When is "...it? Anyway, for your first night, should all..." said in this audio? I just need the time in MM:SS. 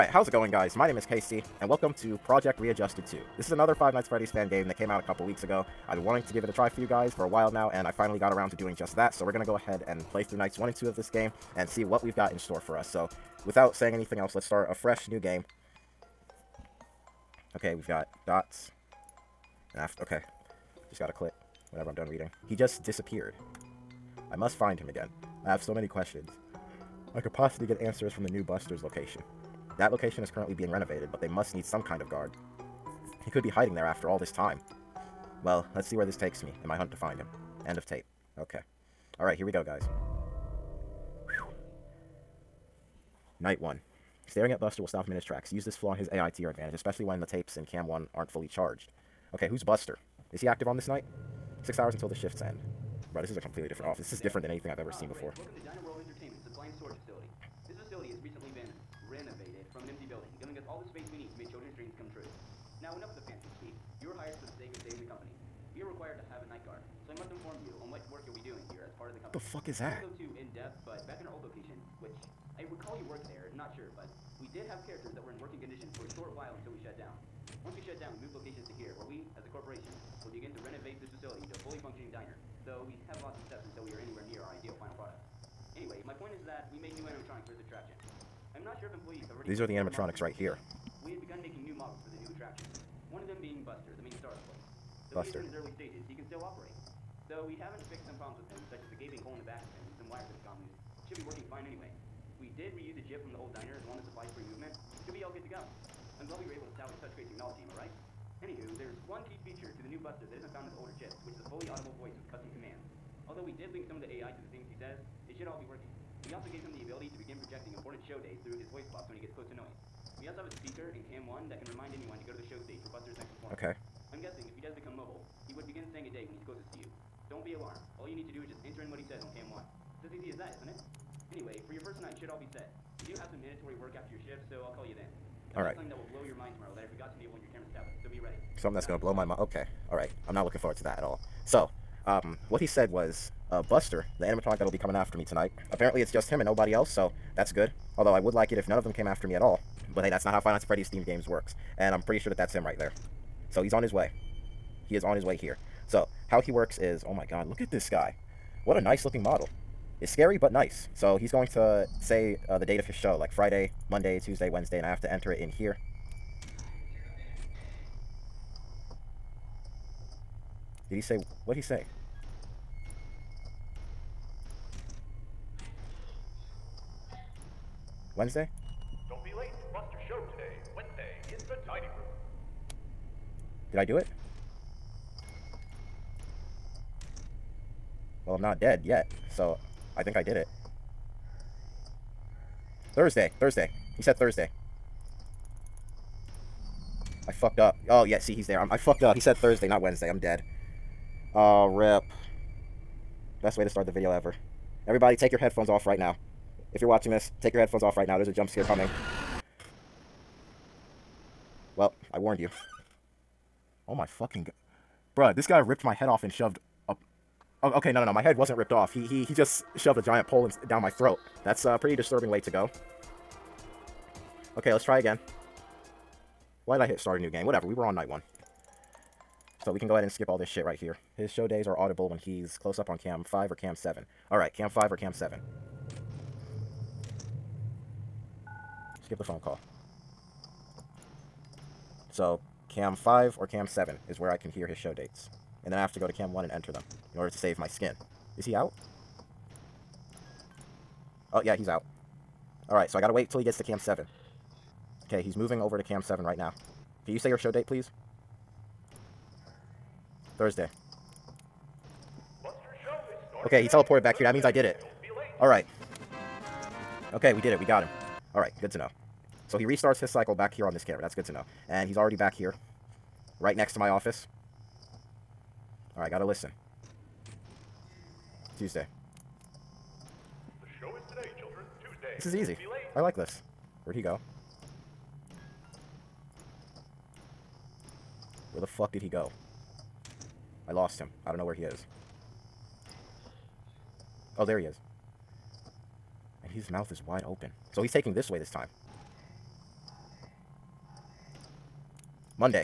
02:10.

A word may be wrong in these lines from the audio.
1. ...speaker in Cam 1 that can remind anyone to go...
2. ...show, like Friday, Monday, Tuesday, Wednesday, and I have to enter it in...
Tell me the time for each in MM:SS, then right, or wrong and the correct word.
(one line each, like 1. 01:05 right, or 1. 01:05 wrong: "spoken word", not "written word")
1. 02:00 right
2. 02:42 right.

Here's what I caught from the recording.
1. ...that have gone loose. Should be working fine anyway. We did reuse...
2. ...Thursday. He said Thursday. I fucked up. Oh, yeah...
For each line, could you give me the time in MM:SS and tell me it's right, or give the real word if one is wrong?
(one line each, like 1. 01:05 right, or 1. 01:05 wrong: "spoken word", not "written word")
1. 01:40 right
2. 03:13 right.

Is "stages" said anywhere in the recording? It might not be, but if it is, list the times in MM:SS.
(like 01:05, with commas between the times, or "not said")
01:35, 02:02.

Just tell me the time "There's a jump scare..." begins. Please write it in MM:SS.
03:28.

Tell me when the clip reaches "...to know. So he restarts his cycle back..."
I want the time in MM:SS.
04:28.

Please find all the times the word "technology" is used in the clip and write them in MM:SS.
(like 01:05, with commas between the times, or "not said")
01:47.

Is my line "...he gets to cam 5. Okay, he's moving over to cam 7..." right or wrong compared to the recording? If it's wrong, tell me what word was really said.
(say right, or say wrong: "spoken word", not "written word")
wrong: "7", not "5".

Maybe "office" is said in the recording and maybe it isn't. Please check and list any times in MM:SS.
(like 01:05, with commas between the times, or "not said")
00:53, 04:33.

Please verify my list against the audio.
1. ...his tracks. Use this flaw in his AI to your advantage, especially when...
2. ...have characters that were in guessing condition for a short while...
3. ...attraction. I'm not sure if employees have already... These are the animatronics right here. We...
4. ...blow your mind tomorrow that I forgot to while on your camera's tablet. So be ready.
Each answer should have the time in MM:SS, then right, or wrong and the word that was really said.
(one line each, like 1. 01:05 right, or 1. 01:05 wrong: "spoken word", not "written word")
1. 00:45 right
2. 01:14 wrong: "working", not "guessing"
3. 01:27 right
4. 02:16 wrong: "enable", not "while".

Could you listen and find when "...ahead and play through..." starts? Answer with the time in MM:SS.
00:09.